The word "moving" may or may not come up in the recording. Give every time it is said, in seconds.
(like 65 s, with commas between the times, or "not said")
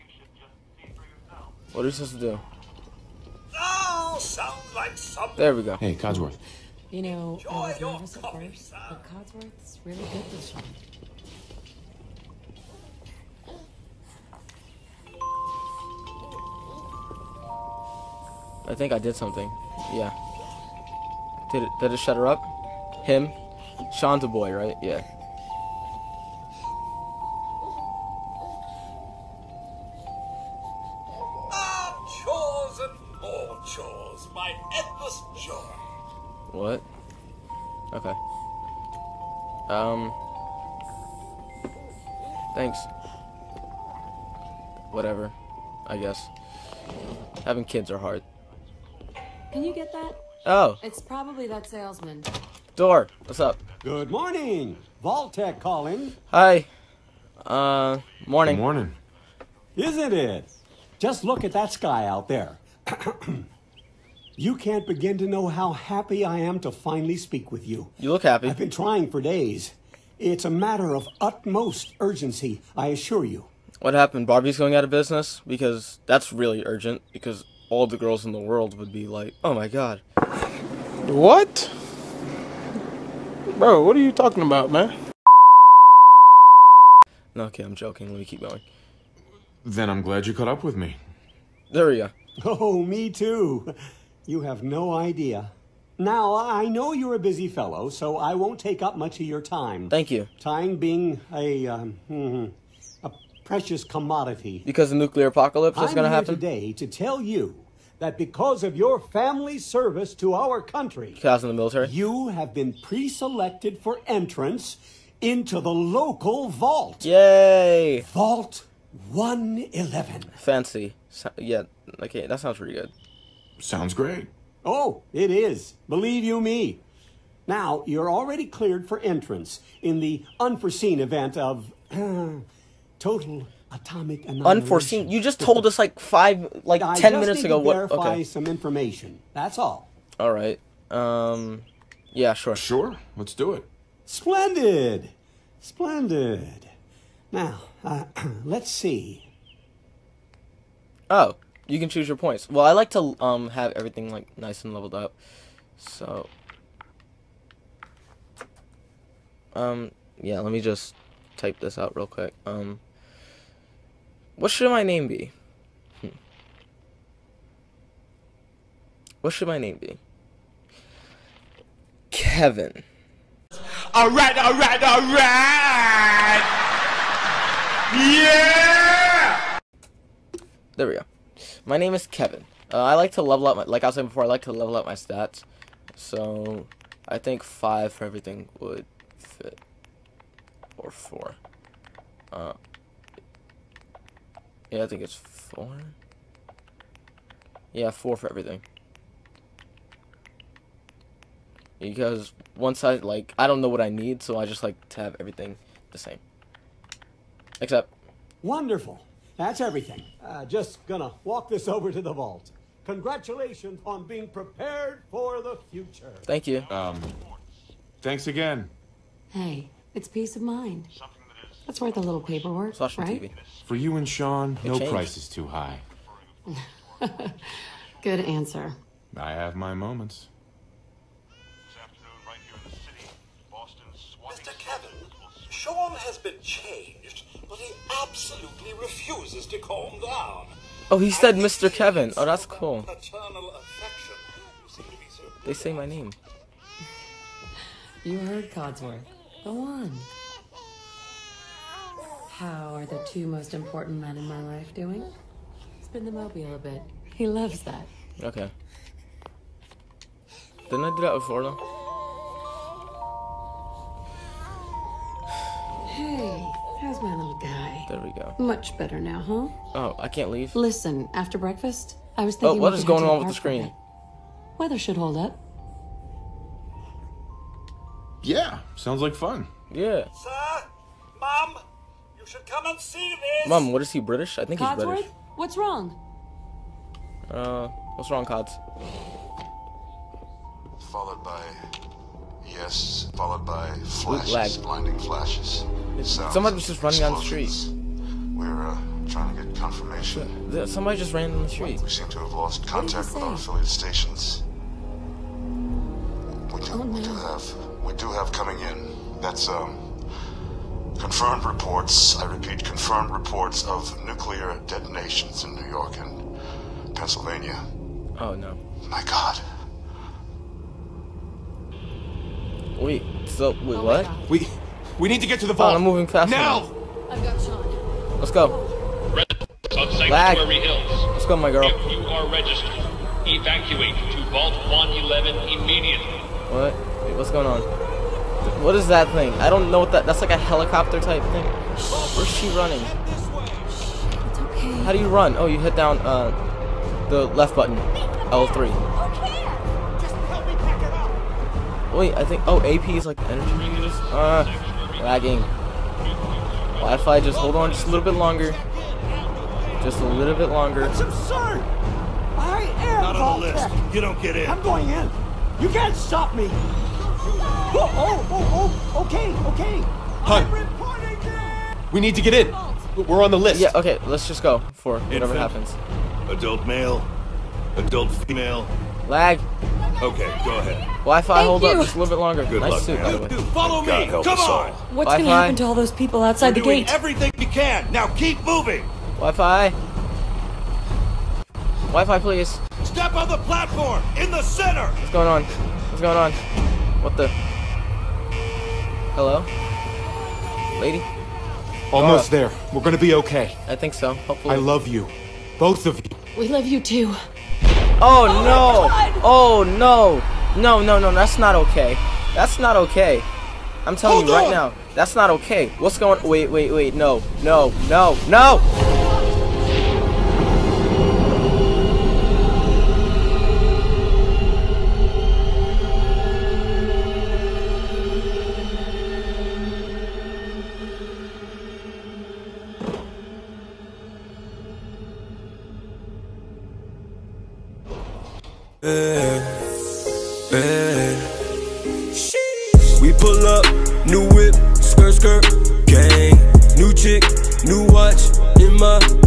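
325 s, 388 s.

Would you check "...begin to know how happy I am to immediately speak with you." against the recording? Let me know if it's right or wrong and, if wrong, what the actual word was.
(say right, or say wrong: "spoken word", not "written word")
wrong: "finally", not "immediately".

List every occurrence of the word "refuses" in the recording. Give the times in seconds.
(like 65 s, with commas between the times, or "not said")
238 s.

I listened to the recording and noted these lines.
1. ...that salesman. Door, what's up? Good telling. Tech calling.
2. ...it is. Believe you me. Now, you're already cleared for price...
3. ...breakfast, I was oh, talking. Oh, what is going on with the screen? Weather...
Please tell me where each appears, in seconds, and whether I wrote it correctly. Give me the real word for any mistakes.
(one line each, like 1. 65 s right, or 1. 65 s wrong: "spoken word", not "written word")
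1. 51 s wrong: "morning", not "telling"
2. 125 s wrong: "entrance", not "price"
3. 271 s wrong: "thinking", not "talking".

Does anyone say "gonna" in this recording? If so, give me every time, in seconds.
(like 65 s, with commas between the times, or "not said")
210 s, 402 s.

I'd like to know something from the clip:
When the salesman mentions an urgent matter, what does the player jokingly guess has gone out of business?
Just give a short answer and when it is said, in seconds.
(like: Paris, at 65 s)
Barbie, at 74 s.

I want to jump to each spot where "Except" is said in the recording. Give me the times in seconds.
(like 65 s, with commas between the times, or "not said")
207 s.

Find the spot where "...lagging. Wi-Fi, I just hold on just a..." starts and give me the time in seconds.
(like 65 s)
355 s.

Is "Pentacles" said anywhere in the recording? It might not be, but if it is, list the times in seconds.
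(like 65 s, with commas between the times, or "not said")
not said.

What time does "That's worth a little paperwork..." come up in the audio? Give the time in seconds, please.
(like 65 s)
221 s.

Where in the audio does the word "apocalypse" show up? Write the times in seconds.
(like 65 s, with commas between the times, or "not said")
105 s.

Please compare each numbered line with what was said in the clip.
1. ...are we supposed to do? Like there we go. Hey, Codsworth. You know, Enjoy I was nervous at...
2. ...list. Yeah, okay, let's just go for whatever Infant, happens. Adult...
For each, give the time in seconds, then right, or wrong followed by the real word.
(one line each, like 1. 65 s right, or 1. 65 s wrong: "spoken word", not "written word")
1. 1 s right
2. 373 s right.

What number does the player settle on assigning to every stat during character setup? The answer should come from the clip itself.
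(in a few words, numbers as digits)
4.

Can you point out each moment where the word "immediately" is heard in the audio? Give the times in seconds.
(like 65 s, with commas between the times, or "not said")
335 s.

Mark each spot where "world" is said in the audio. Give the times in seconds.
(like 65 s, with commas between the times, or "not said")
78 s.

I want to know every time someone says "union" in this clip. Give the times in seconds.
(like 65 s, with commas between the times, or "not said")
not said.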